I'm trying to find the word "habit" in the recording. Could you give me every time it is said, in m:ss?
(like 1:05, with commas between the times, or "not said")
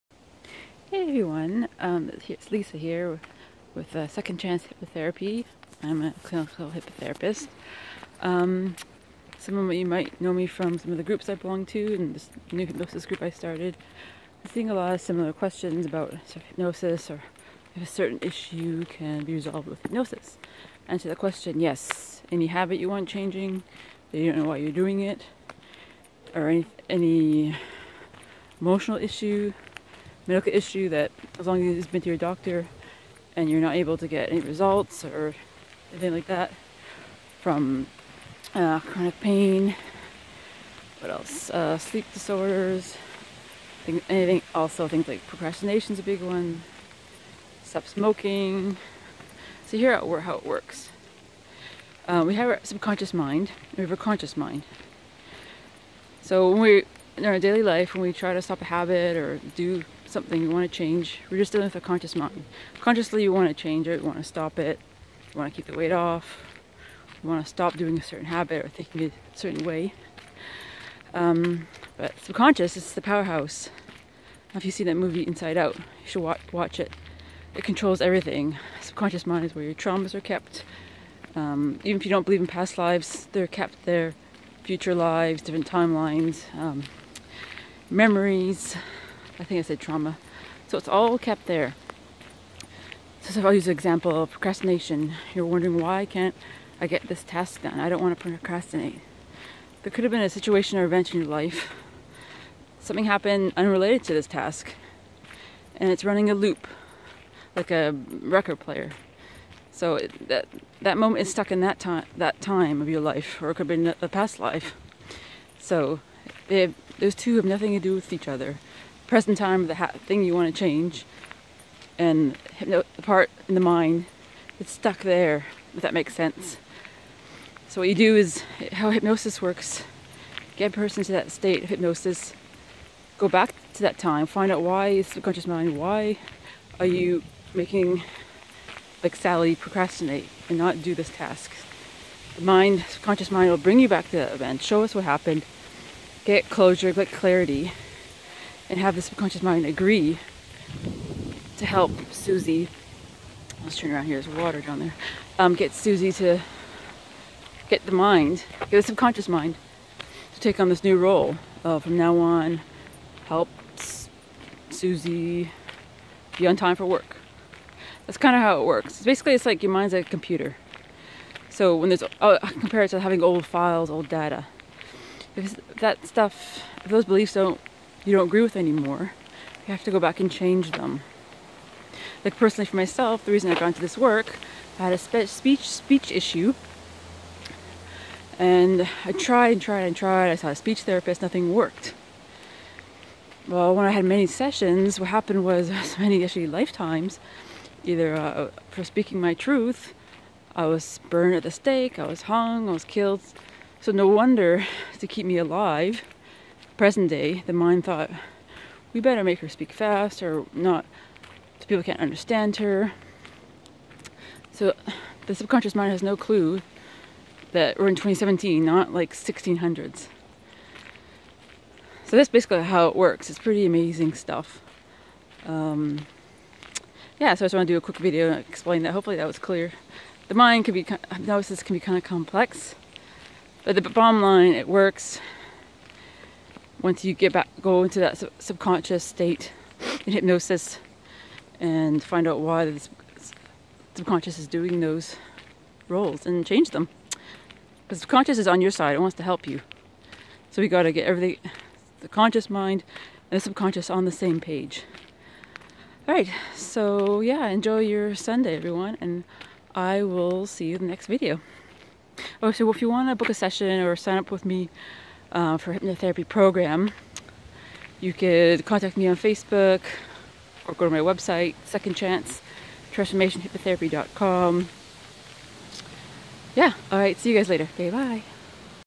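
0:22, 0:58, 1:08.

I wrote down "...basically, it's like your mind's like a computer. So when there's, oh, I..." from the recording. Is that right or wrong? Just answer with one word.
right.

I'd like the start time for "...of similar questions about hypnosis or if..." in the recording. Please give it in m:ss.
0:14.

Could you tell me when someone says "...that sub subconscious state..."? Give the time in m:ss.
3:57.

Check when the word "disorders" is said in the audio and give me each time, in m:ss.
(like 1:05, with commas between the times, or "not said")
0:42.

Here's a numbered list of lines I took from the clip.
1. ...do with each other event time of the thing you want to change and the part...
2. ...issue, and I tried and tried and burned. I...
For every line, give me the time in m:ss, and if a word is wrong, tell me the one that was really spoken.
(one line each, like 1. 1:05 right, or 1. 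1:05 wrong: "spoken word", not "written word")
1. 1:57 wrong: "present", not "event"
2. 3:06 wrong: "tried", not "burned".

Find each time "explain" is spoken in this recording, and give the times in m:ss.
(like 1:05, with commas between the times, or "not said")
3:48.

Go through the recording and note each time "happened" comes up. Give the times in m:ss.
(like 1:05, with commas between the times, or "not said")
1:43, 2:25, 3:15.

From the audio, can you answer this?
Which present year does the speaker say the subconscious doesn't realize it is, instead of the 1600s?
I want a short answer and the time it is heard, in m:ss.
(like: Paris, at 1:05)
2017, at 3:37.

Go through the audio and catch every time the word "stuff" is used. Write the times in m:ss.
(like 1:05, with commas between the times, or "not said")
2:56, 3:44.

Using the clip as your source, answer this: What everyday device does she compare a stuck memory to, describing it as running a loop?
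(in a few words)
A record player.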